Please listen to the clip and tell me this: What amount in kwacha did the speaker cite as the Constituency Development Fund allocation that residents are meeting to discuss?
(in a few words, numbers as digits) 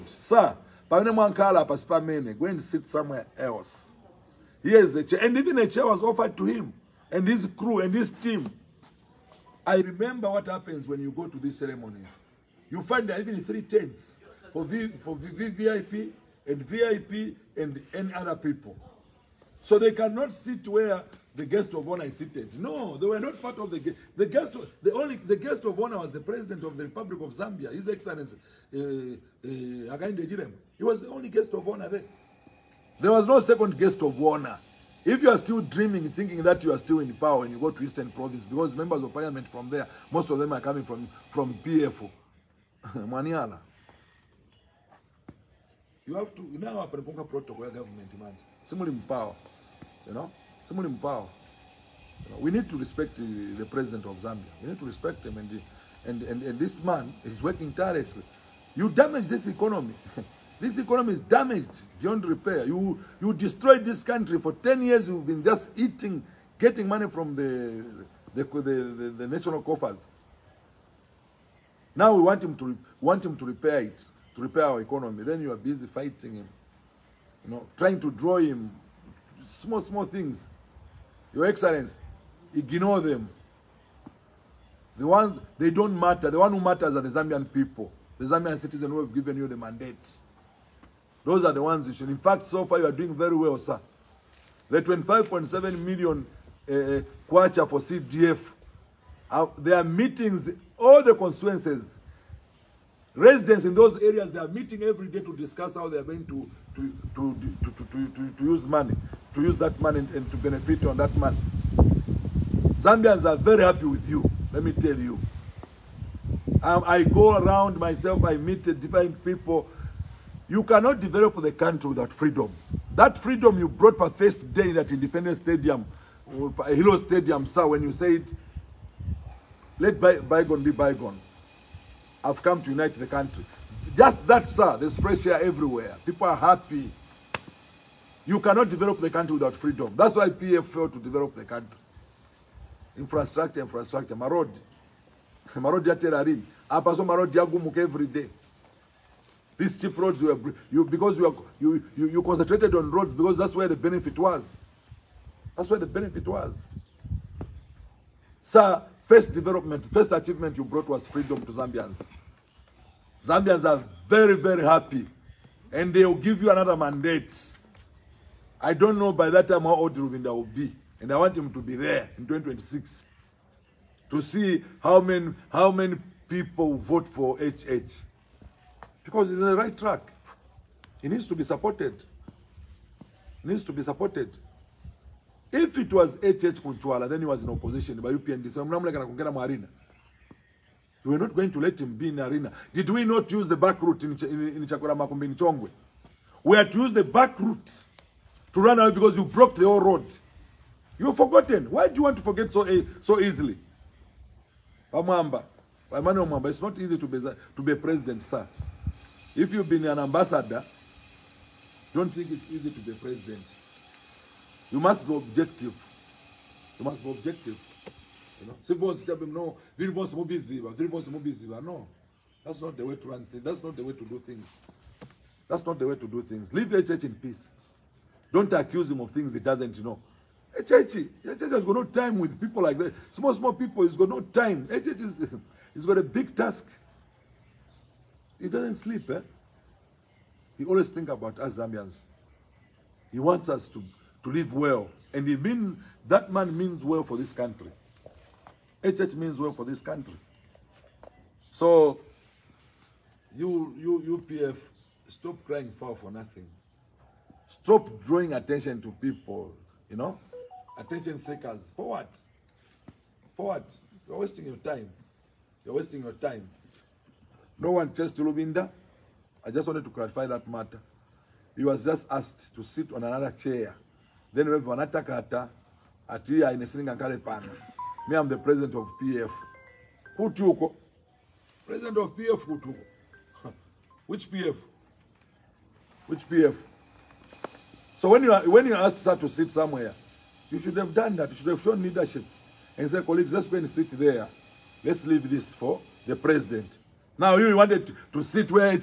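25.7 million.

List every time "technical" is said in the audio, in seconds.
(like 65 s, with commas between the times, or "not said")
not said.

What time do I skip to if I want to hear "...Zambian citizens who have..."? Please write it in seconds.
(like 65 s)
88 s.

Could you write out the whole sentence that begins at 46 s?
You have to now a protocol government demands.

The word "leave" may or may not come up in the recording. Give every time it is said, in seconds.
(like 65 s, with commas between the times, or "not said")
226 s, 295 s.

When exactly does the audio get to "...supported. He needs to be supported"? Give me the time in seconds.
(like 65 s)
181 s.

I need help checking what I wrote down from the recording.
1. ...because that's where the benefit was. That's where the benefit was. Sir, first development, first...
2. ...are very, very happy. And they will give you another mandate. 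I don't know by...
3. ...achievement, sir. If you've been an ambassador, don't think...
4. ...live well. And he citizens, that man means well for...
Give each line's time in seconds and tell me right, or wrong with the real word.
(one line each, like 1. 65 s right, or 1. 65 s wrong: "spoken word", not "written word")
1. 153 s right
2. 163 s right
3. 207 s wrong: "president", not "achievement"
4. 244 s wrong: "means", not "citizens".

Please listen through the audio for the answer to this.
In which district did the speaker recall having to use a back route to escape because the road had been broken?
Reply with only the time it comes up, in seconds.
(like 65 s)
195 s.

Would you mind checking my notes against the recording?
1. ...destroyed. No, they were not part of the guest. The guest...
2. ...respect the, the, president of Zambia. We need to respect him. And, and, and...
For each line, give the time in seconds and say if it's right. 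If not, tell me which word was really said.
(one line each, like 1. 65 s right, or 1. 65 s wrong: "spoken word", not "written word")
1. 22 s wrong: "seated", not "destroyed"
2. 52 s right.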